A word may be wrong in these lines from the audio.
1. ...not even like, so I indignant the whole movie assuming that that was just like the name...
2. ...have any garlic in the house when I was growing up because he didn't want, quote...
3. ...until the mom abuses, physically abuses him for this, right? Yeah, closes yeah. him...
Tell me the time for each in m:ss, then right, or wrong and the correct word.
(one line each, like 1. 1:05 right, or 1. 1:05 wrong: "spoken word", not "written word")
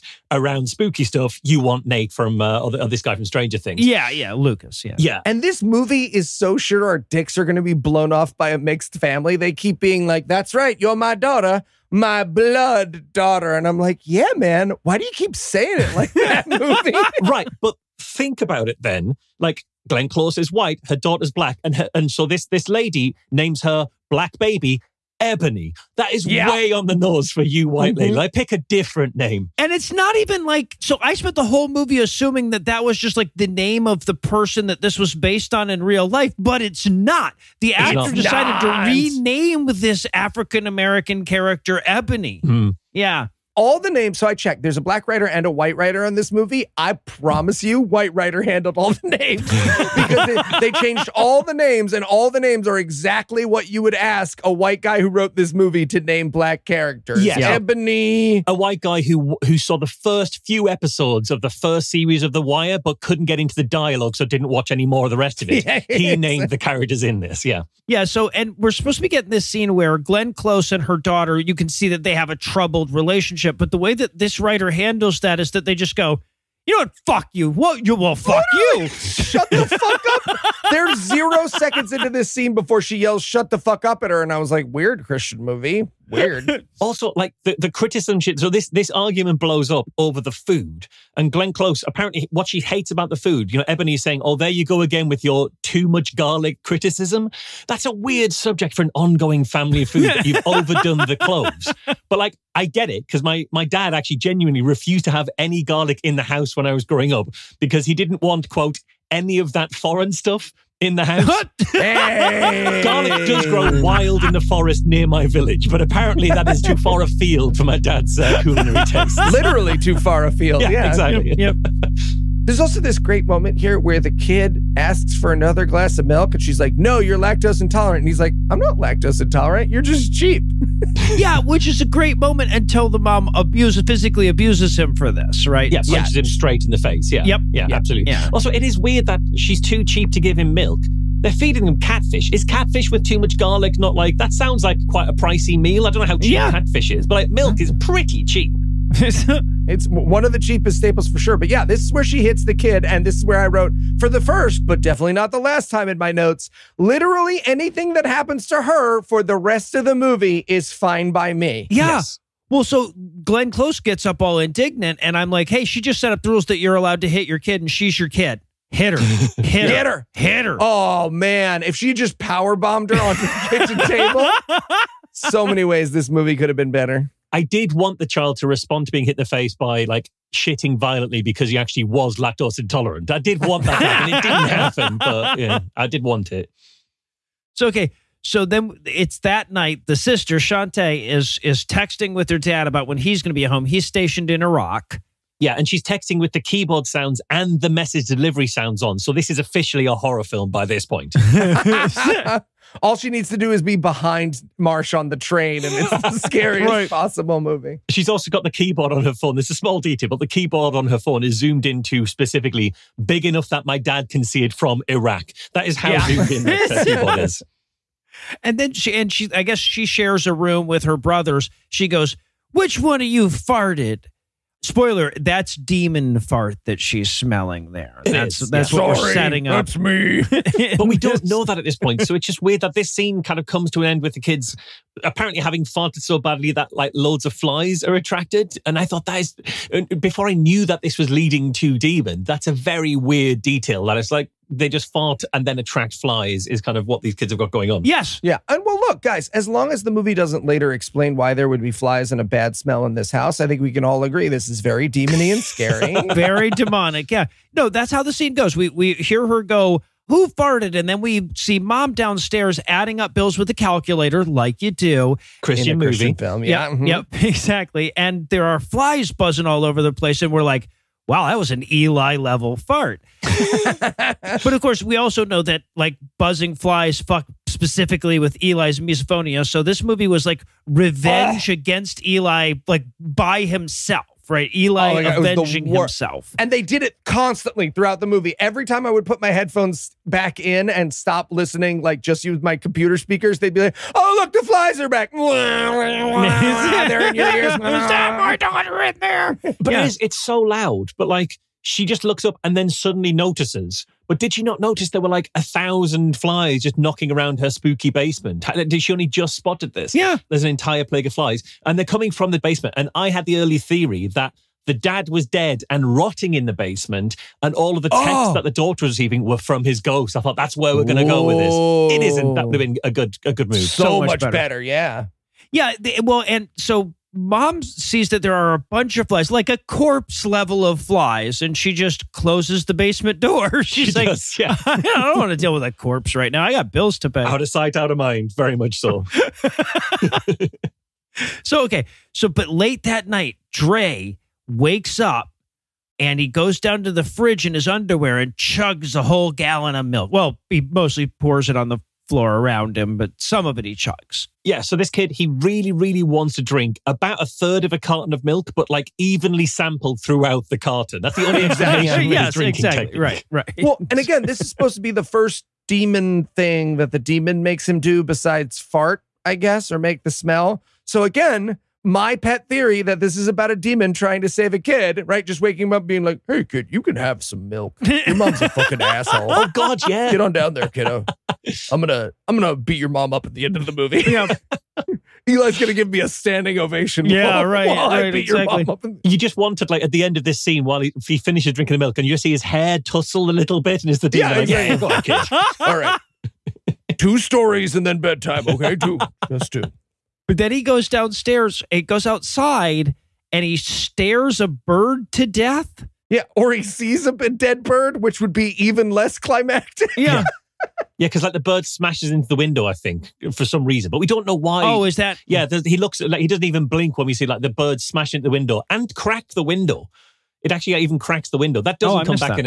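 1. 0:29 wrong: "spent", not "indignant"
2. 1:45 right
3. 2:12 wrong: "punches", not "closes".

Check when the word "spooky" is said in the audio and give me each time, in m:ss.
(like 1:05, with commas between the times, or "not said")
0:00, 5:07.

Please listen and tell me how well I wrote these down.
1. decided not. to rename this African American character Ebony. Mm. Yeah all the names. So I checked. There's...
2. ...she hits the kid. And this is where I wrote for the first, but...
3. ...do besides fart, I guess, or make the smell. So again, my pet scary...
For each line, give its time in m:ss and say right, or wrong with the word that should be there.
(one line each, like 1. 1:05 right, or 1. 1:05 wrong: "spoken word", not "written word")
1. 0:38 right
2. 2:32 right
3. 6:07 wrong: "theory", not "scary".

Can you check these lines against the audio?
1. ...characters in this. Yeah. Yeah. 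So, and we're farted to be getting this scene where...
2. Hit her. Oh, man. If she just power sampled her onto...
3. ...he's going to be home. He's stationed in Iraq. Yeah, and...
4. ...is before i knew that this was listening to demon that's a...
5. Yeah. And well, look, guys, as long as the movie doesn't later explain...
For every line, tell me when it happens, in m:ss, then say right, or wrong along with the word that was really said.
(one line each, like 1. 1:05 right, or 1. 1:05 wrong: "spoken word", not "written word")
1. 1:06 wrong: "supposed", not "farted"
2. 2:50 wrong: "bombed", not "sampled"
3. 3:12 right
4. 3:59 wrong: "leading", not "listening"
5. 4:08 right.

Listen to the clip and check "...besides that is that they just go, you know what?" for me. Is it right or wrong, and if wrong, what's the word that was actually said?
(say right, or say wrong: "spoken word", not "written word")
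wrong: "handles", not "besides".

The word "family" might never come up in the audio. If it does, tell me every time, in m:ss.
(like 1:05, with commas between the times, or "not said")
0:08, 1:39.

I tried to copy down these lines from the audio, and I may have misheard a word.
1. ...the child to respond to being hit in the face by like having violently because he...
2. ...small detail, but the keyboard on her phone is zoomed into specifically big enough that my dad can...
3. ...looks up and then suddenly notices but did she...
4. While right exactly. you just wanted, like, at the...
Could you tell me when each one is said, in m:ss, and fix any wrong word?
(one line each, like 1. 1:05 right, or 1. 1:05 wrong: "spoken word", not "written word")
1. 2:57 wrong: "shitting", not "having"
2. 3:29 right
3. 5:02 right
4. 6:27 right.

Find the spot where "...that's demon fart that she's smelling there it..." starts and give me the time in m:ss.
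3:45.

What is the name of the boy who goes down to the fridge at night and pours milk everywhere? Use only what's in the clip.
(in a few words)
Dre.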